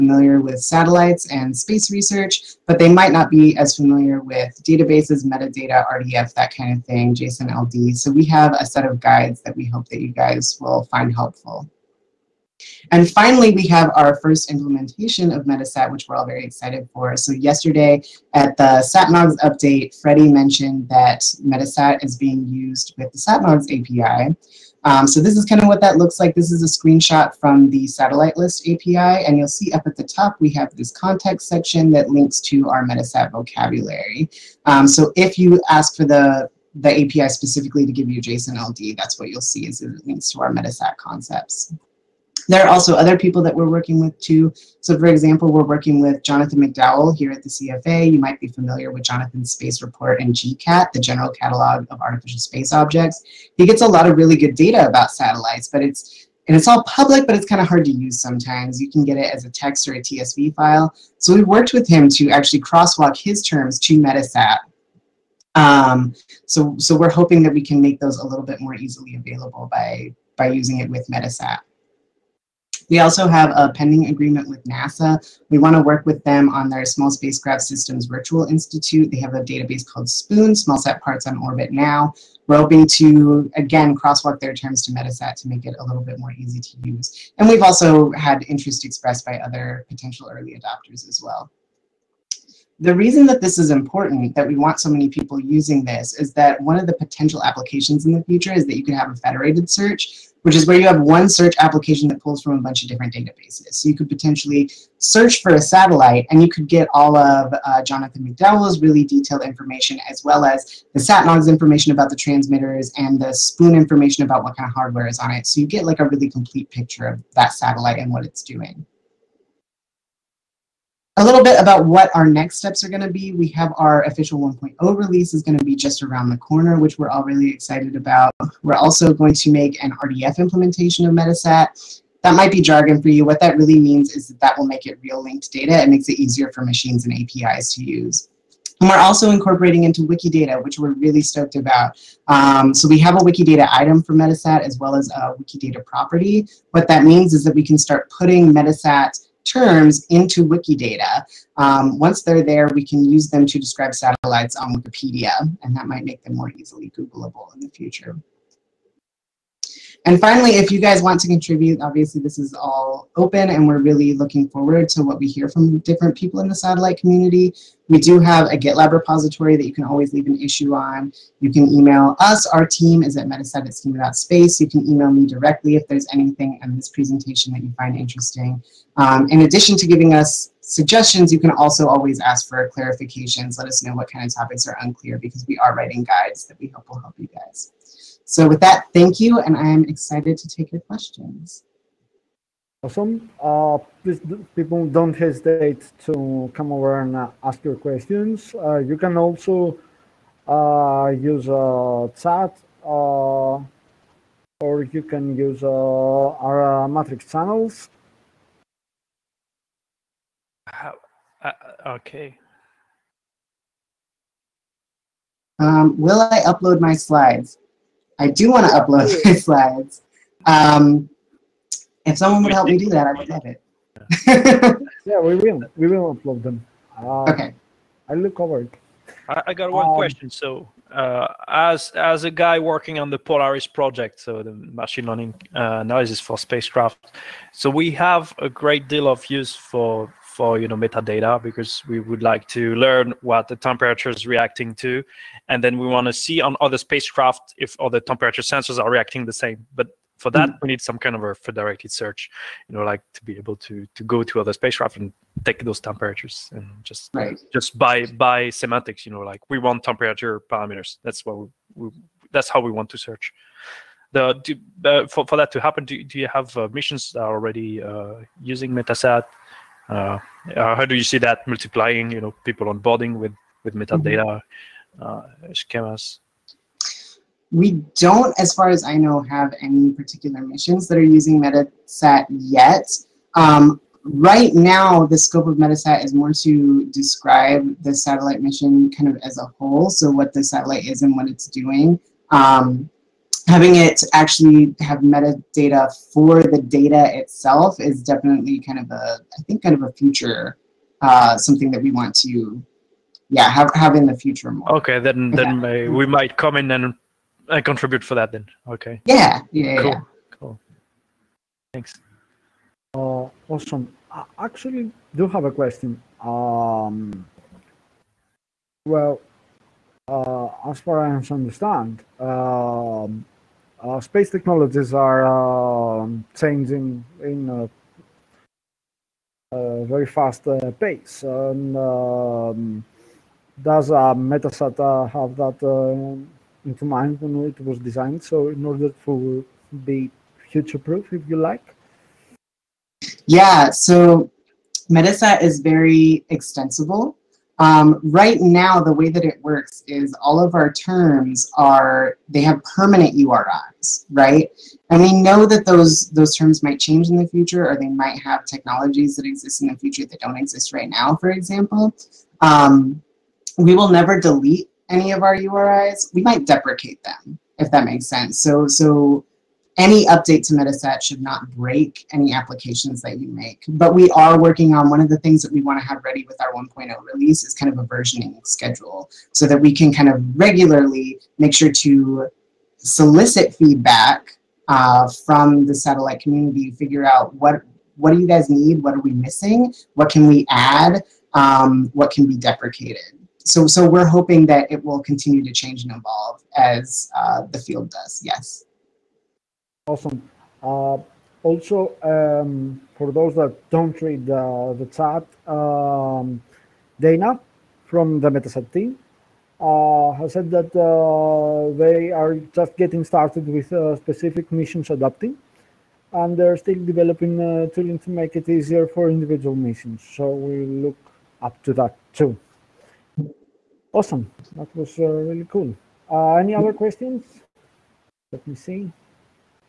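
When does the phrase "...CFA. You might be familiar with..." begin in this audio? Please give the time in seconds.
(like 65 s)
47 s.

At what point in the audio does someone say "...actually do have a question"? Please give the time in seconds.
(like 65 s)
314 s.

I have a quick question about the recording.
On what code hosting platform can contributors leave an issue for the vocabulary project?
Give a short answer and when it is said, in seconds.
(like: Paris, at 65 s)
GitLab, at 168 s.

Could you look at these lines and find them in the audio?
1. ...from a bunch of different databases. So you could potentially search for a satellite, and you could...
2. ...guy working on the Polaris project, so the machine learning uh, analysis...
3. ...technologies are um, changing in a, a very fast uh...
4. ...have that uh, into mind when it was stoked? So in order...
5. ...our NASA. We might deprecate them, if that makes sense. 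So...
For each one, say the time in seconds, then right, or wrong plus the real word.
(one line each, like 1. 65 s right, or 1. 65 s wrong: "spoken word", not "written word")
1. 102 s right
2. 232 s right
3. 324 s right
4. 335 s wrong: "designed", not "stoked"
5. 365 s wrong: "URIs", not "NASA".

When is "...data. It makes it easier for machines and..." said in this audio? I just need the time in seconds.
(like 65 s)
135 s.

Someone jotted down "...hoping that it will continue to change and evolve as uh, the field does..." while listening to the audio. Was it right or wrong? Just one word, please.
right.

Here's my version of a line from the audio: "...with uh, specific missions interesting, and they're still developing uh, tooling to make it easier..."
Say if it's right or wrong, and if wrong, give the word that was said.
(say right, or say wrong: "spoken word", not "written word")
wrong: "adapting", not "interesting".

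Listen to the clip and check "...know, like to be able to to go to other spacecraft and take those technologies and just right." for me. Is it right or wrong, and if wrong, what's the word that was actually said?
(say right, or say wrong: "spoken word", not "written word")
wrong: "temperatures", not "technologies".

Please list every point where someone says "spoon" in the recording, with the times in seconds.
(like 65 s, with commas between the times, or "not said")
80 s, 113 s.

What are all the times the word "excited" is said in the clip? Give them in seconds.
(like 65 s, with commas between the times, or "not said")
16 s, 127 s, 189 s.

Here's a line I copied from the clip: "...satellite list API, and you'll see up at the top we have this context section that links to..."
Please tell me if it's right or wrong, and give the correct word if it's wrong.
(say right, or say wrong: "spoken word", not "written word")
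right.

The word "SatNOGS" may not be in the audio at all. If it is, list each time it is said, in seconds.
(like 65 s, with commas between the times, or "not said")
18 s, 23 s, 110 s.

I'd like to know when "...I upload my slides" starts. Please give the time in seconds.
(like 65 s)
216 s.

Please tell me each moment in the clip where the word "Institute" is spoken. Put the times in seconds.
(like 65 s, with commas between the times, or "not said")
78 s.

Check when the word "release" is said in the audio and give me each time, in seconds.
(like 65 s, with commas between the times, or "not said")
124 s, 377 s.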